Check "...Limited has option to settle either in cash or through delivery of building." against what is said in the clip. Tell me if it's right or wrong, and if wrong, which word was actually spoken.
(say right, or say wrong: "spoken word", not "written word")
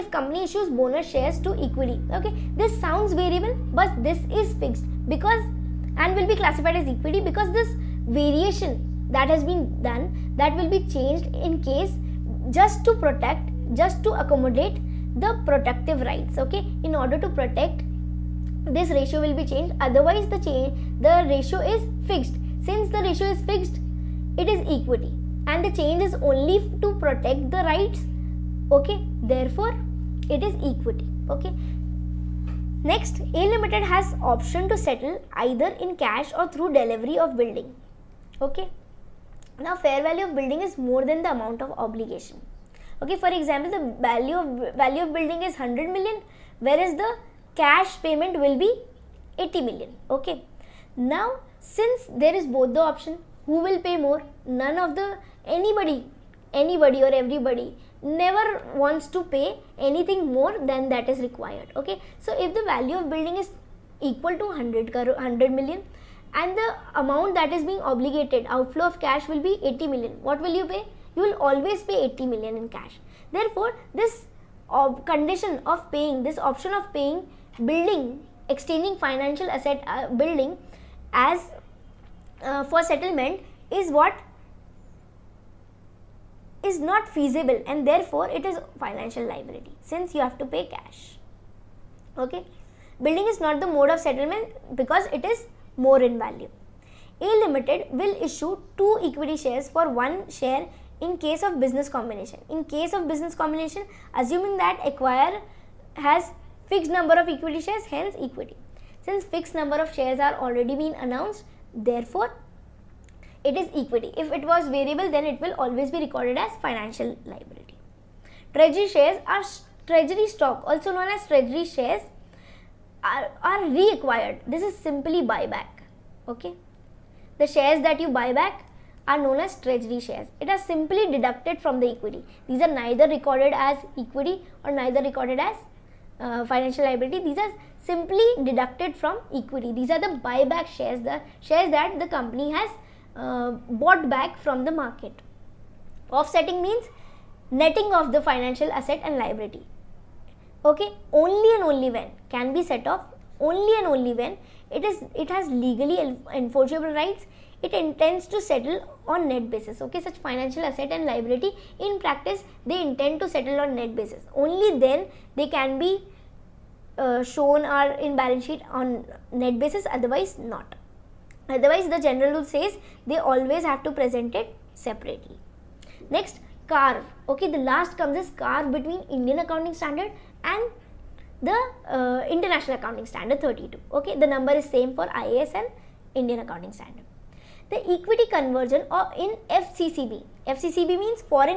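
right.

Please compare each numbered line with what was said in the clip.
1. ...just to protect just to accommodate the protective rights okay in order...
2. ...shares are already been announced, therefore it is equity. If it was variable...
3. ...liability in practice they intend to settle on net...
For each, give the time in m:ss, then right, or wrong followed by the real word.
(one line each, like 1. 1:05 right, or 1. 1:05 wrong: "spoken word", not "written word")
1. 0:12 right
2. 1:49 right
3. 2:41 right.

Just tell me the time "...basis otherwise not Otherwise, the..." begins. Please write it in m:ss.
2:49.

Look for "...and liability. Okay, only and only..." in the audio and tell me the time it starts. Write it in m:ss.
2:29.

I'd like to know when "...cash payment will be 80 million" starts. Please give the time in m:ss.
0:47.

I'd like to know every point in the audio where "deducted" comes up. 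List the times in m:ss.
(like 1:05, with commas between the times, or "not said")
2:11, 2:18.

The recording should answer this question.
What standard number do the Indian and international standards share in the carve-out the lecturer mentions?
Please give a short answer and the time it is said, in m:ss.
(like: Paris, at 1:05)
32, at 3:03.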